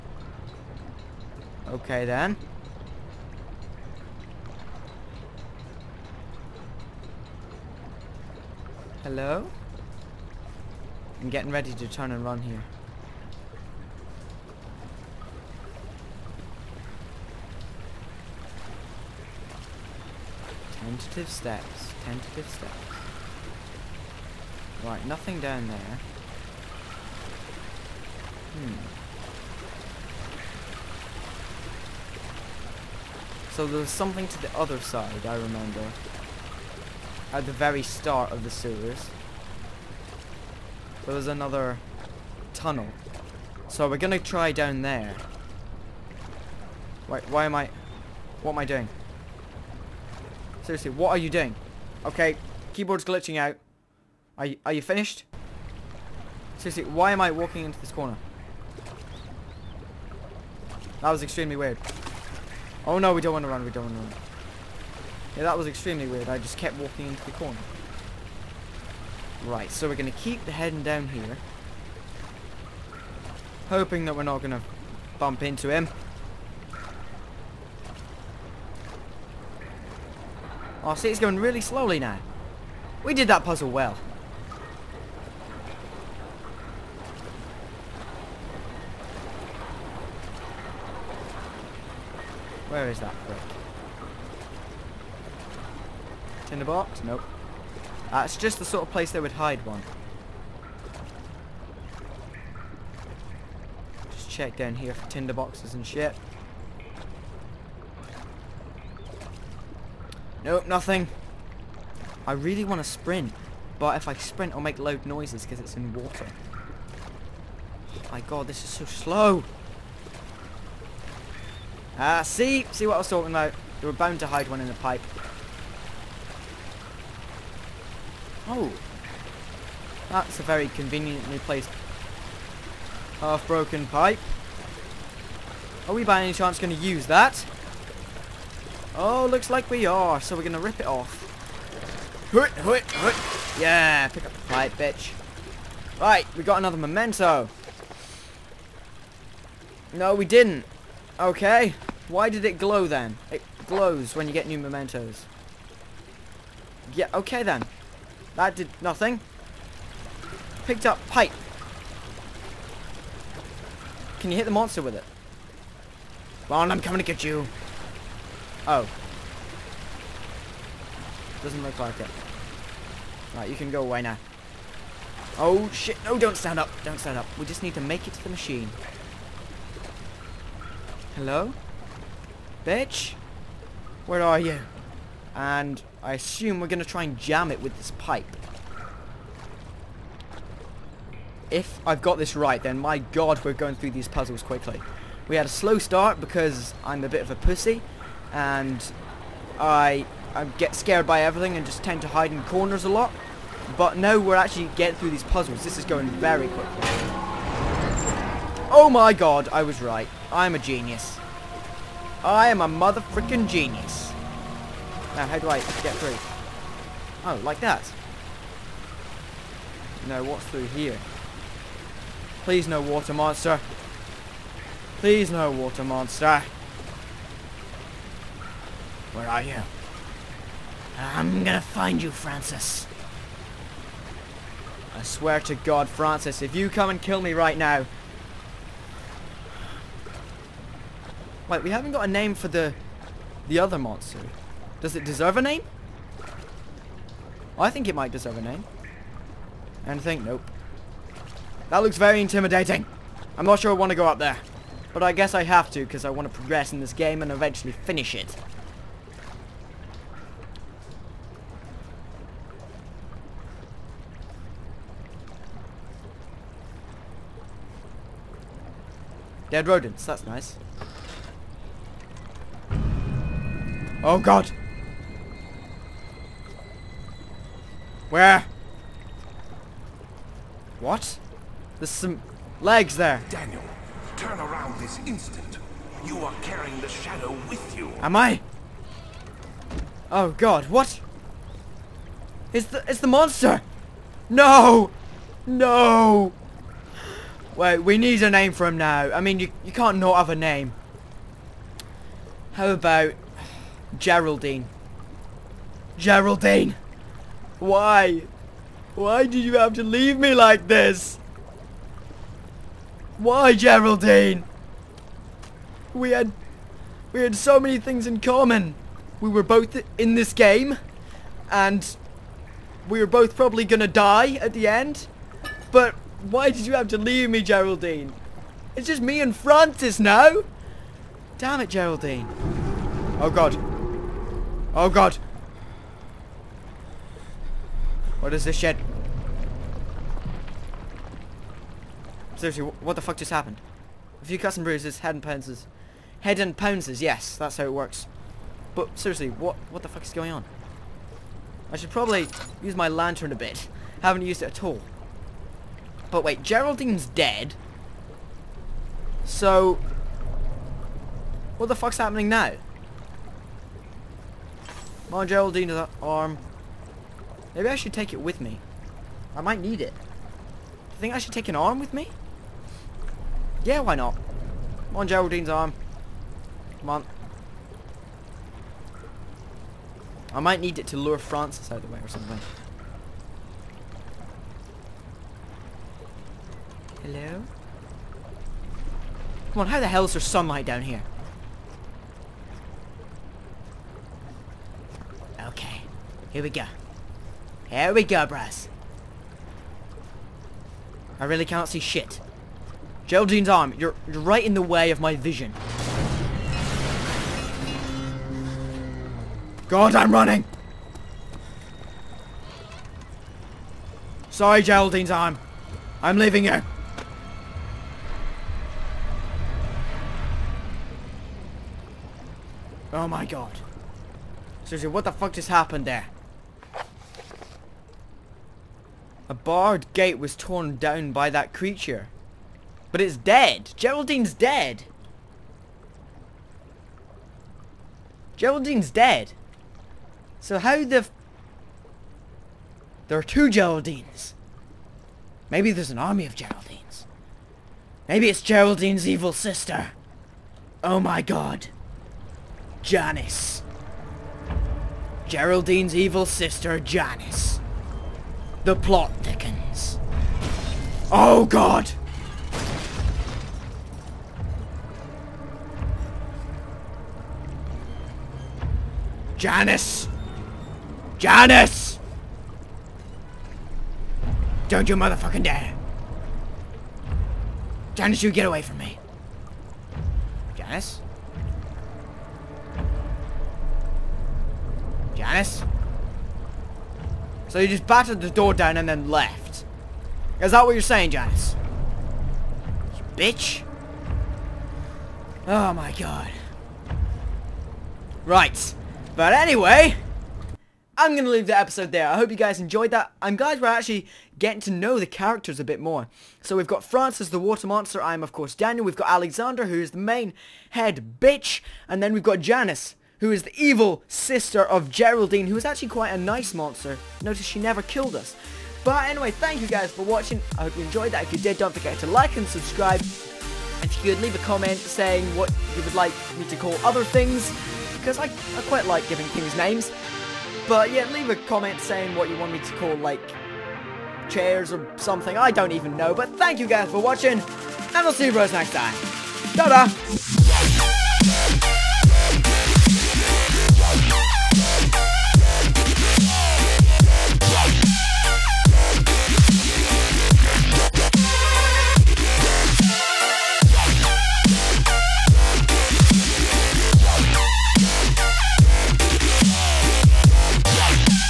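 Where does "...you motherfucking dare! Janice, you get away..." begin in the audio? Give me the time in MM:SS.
07:54.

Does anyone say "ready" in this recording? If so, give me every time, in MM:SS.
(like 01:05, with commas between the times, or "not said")
00:11.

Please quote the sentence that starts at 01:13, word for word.
Hoping that we're not going to bump into him.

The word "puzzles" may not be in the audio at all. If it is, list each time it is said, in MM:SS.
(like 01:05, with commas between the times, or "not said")
01:23, 03:14, 03:25.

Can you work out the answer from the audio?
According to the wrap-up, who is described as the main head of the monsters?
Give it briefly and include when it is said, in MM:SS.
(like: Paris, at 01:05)
Alexander, at 08:29.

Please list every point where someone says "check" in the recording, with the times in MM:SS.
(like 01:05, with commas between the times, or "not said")
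01:44.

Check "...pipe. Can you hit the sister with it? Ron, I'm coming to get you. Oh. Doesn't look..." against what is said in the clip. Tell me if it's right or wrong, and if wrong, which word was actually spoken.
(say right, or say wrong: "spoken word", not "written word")
wrong: "monster", not "sister".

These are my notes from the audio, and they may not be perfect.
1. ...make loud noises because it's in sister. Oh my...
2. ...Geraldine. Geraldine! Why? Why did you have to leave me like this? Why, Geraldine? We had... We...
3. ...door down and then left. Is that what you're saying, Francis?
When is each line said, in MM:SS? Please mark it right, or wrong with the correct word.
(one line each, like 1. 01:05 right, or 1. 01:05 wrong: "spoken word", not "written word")
1. 01:54 wrong: "water", not "sister"
2. 05:03 right
3. 08:08 wrong: "Janice", not "Francis".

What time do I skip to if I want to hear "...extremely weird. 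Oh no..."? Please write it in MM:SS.
01:01.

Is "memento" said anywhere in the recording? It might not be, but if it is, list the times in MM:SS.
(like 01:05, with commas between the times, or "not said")
02:26, 02:34.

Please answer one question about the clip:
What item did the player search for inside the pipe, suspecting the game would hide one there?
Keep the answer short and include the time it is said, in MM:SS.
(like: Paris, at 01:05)
Tinderbox, at 01:36.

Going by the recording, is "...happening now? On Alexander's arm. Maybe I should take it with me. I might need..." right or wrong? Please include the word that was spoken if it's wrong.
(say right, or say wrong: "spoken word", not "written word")
wrong: "Geraldine", not "Alexander".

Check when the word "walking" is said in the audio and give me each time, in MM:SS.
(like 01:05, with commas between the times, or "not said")
00:57, 01:06.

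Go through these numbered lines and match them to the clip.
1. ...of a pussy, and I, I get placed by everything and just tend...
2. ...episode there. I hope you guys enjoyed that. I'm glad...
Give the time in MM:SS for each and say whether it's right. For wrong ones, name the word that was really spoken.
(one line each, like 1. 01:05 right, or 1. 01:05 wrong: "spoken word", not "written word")
1. 03:17 wrong: "scared", not "placed"
2. 08:21 right.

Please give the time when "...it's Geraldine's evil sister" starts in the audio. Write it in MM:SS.
07:28.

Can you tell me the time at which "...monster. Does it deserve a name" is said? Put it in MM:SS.
04:03.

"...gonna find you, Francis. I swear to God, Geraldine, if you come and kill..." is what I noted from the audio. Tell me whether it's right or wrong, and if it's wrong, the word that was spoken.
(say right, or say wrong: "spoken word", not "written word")
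wrong: "Francis", not "Geraldine".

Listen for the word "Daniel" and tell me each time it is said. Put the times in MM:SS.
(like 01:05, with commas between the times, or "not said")
04:43, 08:28.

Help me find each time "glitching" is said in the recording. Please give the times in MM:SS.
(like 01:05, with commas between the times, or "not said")
00:53.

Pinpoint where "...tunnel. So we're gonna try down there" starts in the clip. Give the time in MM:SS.
00:42.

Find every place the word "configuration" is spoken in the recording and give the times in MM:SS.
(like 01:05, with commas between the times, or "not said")
not said.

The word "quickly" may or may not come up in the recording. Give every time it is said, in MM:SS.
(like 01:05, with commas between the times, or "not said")
03:14, 03:26.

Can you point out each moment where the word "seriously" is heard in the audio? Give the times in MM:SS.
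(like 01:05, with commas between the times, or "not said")
00:50, 00:56, 05:42, 05:48, 07:04.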